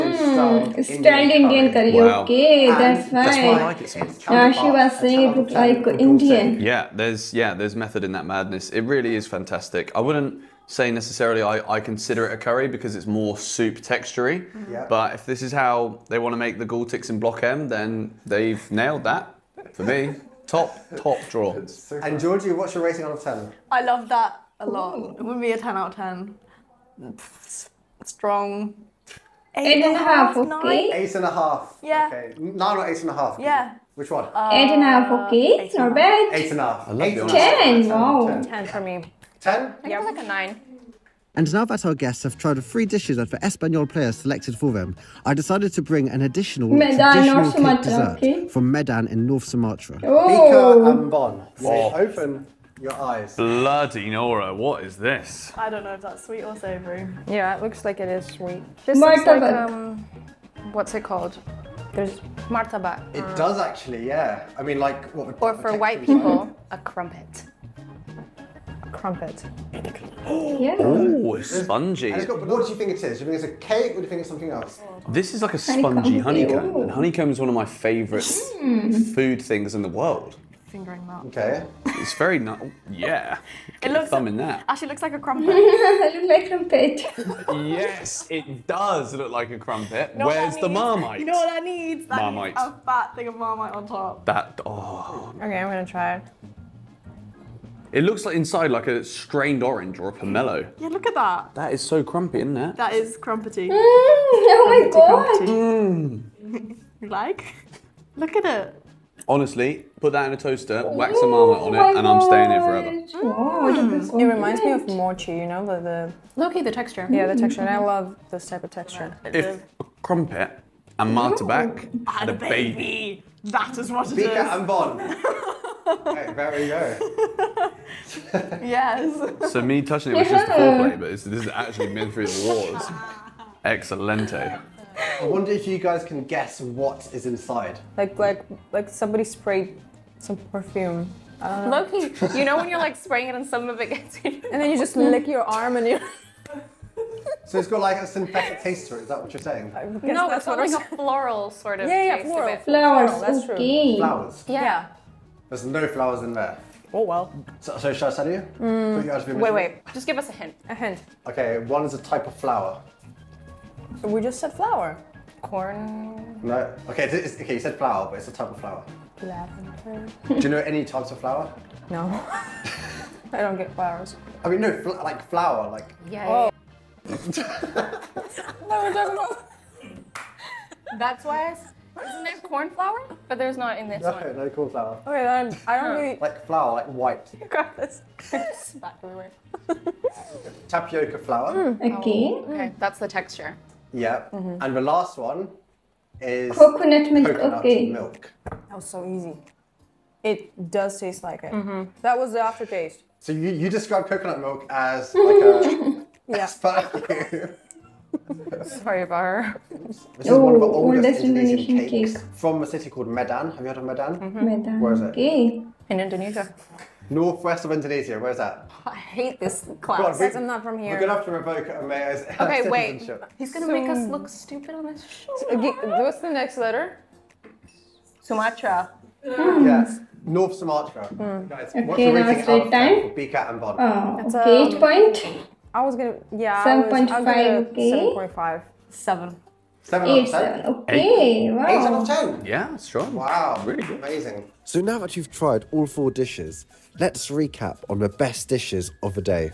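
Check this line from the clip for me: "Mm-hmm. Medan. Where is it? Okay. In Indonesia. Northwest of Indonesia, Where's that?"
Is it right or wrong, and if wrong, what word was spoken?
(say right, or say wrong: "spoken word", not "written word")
right.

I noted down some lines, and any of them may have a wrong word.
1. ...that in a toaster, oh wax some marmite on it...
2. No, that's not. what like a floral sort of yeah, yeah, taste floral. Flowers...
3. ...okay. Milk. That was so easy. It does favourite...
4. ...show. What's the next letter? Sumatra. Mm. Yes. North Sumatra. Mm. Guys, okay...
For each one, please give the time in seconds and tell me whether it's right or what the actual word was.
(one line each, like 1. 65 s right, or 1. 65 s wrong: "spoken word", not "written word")
1. 110 s right
2. 150 s right
3. 197 s wrong: "taste", not "favourite"
4. 225 s right.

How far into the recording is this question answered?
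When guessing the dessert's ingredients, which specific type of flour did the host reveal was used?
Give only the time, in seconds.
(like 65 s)
190 s.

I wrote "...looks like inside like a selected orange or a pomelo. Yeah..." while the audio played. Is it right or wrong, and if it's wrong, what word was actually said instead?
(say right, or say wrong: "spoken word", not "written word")
wrong: "strained", not "selected".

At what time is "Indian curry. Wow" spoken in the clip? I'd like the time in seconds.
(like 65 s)
1 s.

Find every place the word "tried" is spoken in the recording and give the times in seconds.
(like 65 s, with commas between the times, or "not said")
42 s, 245 s.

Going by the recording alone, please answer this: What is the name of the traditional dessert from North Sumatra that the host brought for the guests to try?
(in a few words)
Bika Ambon.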